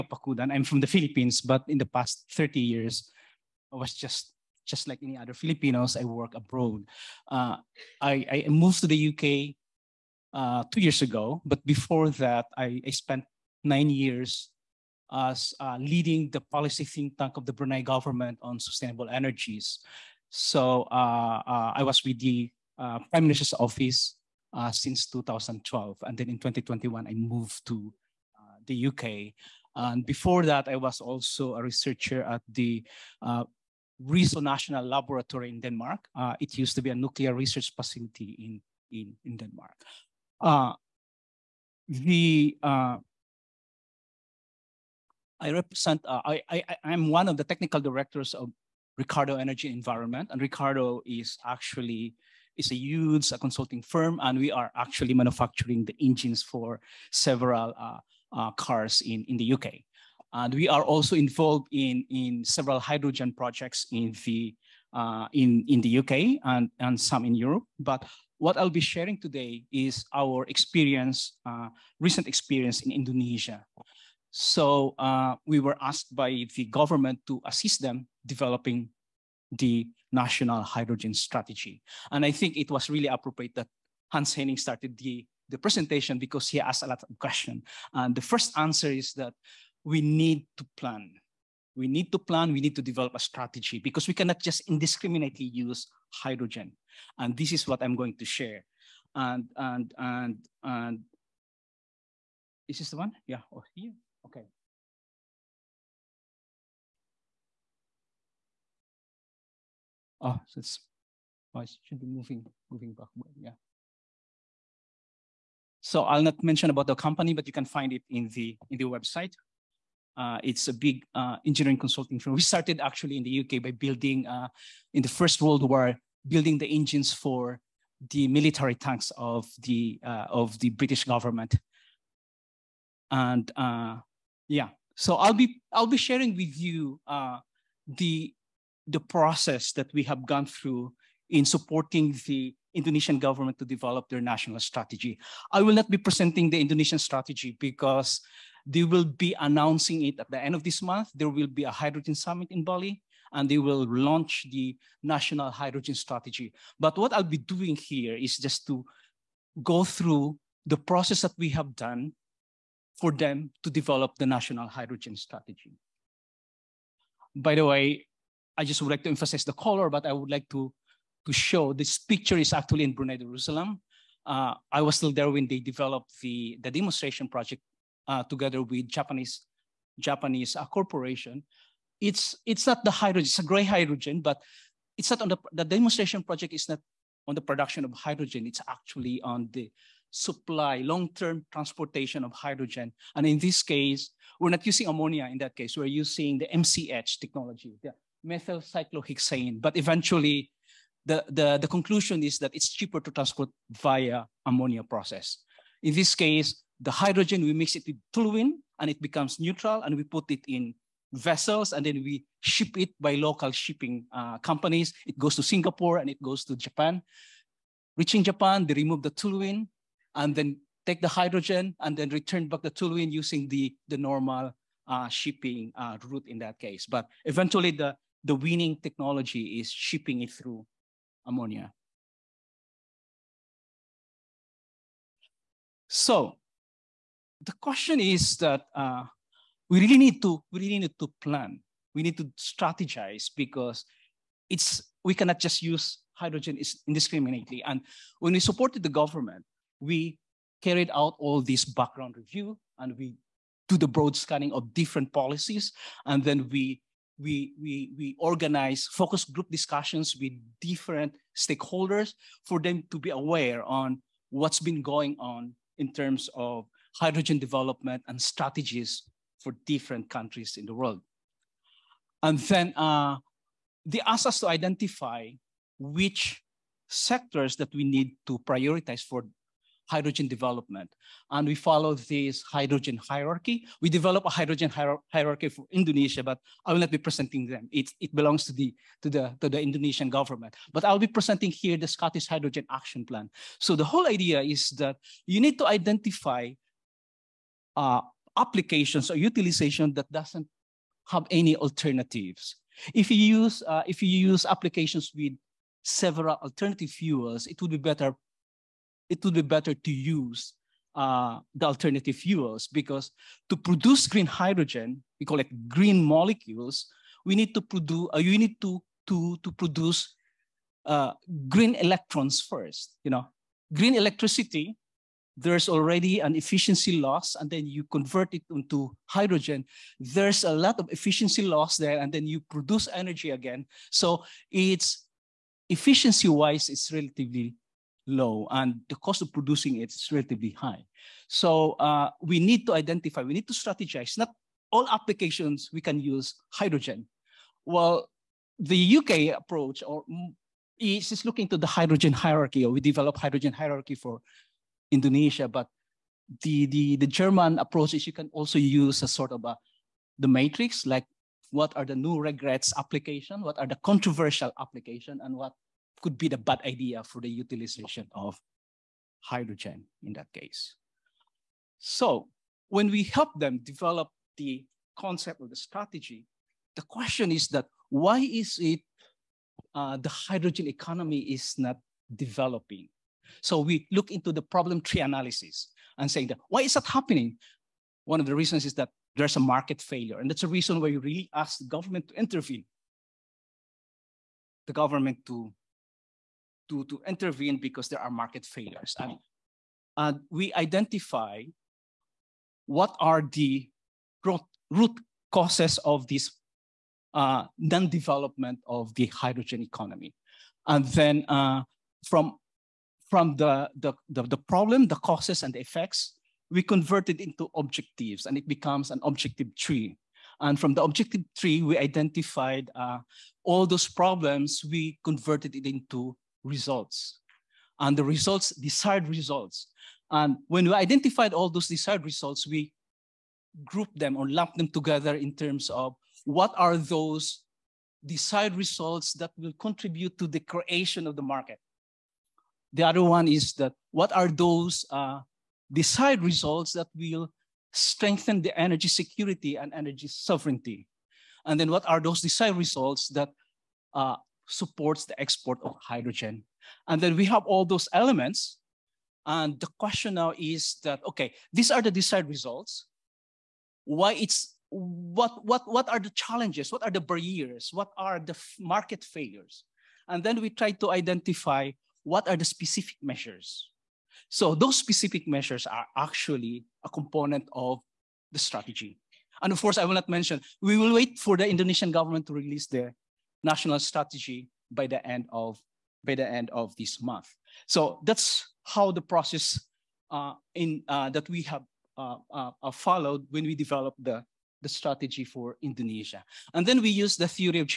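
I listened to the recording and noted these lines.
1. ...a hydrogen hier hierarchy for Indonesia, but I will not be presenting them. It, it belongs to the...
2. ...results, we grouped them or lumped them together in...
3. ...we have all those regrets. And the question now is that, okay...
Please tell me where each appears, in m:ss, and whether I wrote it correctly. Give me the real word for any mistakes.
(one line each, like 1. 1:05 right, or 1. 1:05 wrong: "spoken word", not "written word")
1. 4:44 right
2. 7:12 right
3. 7:37 wrong: "elements", not "regrets".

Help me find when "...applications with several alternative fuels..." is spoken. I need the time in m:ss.
5:04.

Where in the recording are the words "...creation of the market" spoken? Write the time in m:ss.
7:20.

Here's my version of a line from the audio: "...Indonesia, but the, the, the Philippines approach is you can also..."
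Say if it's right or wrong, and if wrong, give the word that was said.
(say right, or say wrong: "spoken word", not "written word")
wrong: "German", not "Philippines".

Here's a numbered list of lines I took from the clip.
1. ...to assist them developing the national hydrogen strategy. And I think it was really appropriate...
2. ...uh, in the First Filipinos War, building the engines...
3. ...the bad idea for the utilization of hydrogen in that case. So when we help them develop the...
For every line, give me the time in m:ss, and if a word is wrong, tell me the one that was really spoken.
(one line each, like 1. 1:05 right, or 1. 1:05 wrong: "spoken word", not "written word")
1. 1:17 right
2. 2:04 wrong: "World", not "Filipinos"
3. 6:06 right.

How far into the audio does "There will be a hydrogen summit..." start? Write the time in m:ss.
2:31.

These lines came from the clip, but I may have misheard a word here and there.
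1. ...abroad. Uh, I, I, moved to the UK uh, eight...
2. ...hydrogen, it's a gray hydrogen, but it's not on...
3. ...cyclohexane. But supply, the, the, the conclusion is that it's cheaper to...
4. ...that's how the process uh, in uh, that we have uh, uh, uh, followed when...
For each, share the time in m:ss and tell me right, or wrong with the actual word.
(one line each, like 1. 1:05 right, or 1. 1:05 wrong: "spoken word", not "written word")
1. 0:06 wrong: "two", not "eight"
2. 3:02 right
3. 3:18 wrong: "eventually", not "supply"
4. 8:08 right.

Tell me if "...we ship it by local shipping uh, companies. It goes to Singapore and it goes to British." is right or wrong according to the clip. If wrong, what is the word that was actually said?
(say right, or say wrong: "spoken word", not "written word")
wrong: "Japan", not "British".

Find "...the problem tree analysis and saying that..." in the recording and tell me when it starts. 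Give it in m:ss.
6:24.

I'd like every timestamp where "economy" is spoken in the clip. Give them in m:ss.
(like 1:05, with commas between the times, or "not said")
6:20, 6:49.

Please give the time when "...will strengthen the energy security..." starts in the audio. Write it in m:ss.
7:26.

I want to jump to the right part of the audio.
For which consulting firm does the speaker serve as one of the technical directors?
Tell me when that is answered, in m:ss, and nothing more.
0:48.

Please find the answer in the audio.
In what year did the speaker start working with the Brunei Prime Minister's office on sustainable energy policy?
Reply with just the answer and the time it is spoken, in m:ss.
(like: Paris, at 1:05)
2012, at 0:25.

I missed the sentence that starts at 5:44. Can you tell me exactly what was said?
Not all applications we can use hydrogen.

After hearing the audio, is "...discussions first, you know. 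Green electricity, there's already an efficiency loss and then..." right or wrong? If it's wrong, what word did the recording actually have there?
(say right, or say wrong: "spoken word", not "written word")
wrong: "electrons", not "discussions".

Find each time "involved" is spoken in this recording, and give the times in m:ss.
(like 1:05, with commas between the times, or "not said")
1:01.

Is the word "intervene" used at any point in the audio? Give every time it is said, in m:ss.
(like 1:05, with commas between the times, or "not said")
6:32, 6:37.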